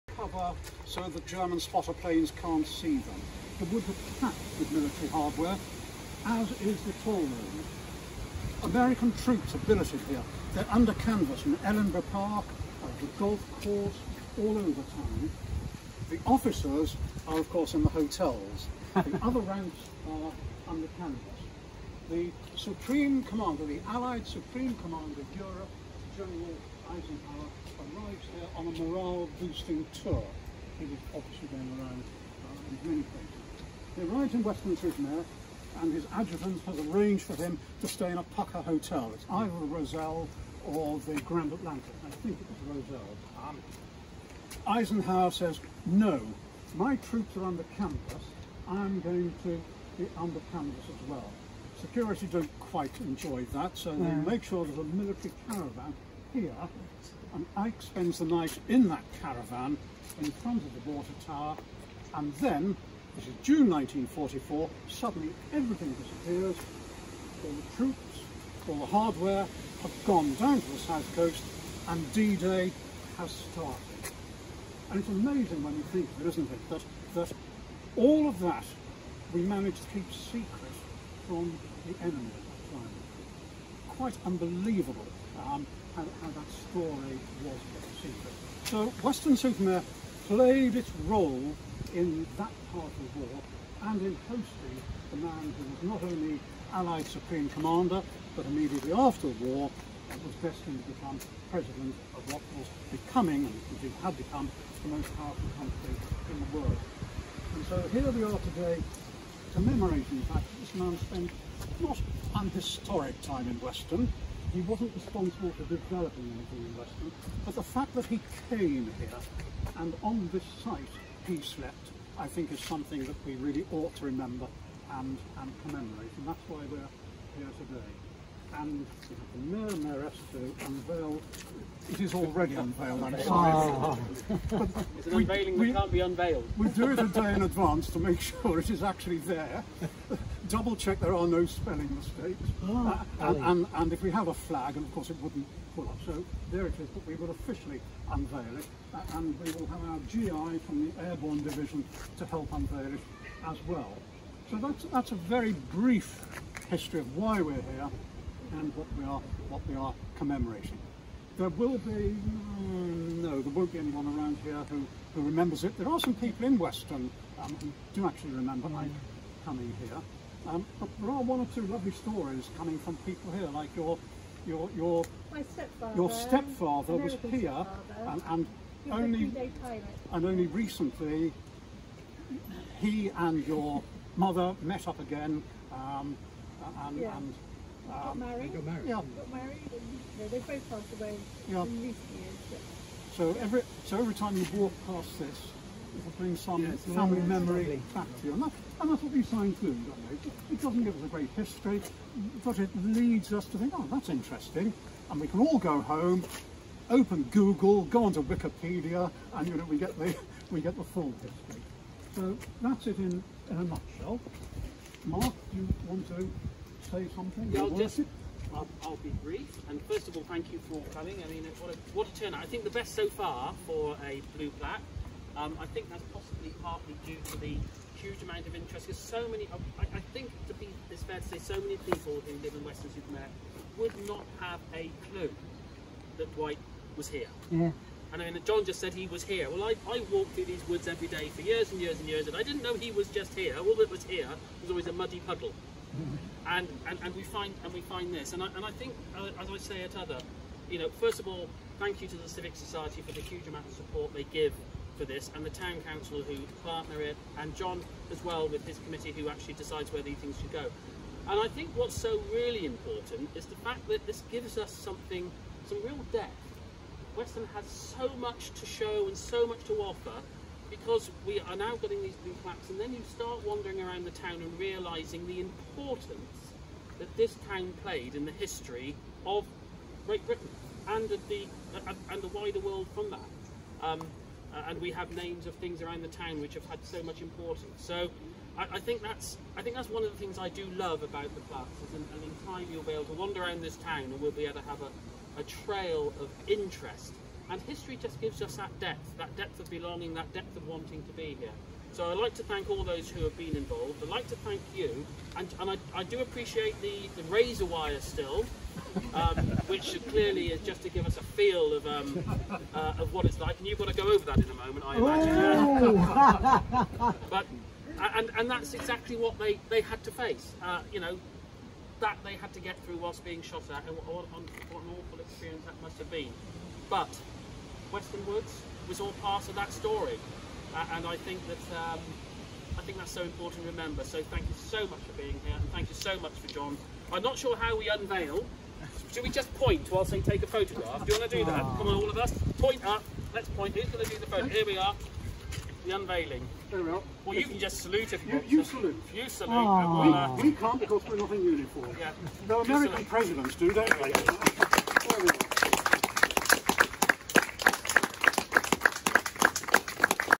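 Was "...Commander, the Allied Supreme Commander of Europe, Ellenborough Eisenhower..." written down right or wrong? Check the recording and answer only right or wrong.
wrong.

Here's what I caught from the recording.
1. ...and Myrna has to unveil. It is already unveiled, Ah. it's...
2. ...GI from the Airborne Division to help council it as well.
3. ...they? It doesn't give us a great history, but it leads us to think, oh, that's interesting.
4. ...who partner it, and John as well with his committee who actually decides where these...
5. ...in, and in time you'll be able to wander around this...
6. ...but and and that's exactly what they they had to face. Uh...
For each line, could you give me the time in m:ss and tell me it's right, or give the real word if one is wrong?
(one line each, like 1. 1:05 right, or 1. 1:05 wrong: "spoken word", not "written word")
1. 2:08 right
2. 2:30 wrong: "unveil", not "council"
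3. 3:20 right
4. 4:16 right
5. 4:51 right
6. 5:17 right.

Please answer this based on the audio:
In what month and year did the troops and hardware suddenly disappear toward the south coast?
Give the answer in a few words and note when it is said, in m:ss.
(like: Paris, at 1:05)
June 1944, at 1:03.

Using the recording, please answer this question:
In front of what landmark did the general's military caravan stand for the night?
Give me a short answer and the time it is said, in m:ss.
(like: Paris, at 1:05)
the water tower, at 1:00.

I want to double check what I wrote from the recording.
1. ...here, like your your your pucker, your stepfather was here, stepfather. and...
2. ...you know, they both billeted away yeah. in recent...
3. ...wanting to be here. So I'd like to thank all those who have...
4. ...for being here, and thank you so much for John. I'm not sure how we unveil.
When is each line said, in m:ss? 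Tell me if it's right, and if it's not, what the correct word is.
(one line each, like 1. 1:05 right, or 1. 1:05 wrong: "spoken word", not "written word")
1. 2:53 wrong: "stepfather", not "pucker"
2. 3:10 wrong: "passed", not "billeted"
3. 5:00 right
4. 5:34 right.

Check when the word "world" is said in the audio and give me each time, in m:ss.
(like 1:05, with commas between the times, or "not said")
1:46, 4:42.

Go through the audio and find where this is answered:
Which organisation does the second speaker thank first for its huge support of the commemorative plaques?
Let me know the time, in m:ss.
4:12.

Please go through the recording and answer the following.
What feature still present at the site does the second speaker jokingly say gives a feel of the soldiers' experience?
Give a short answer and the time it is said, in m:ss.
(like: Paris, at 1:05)
razor wire, at 5:07.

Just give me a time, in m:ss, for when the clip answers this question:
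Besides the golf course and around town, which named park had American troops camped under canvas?
0:11.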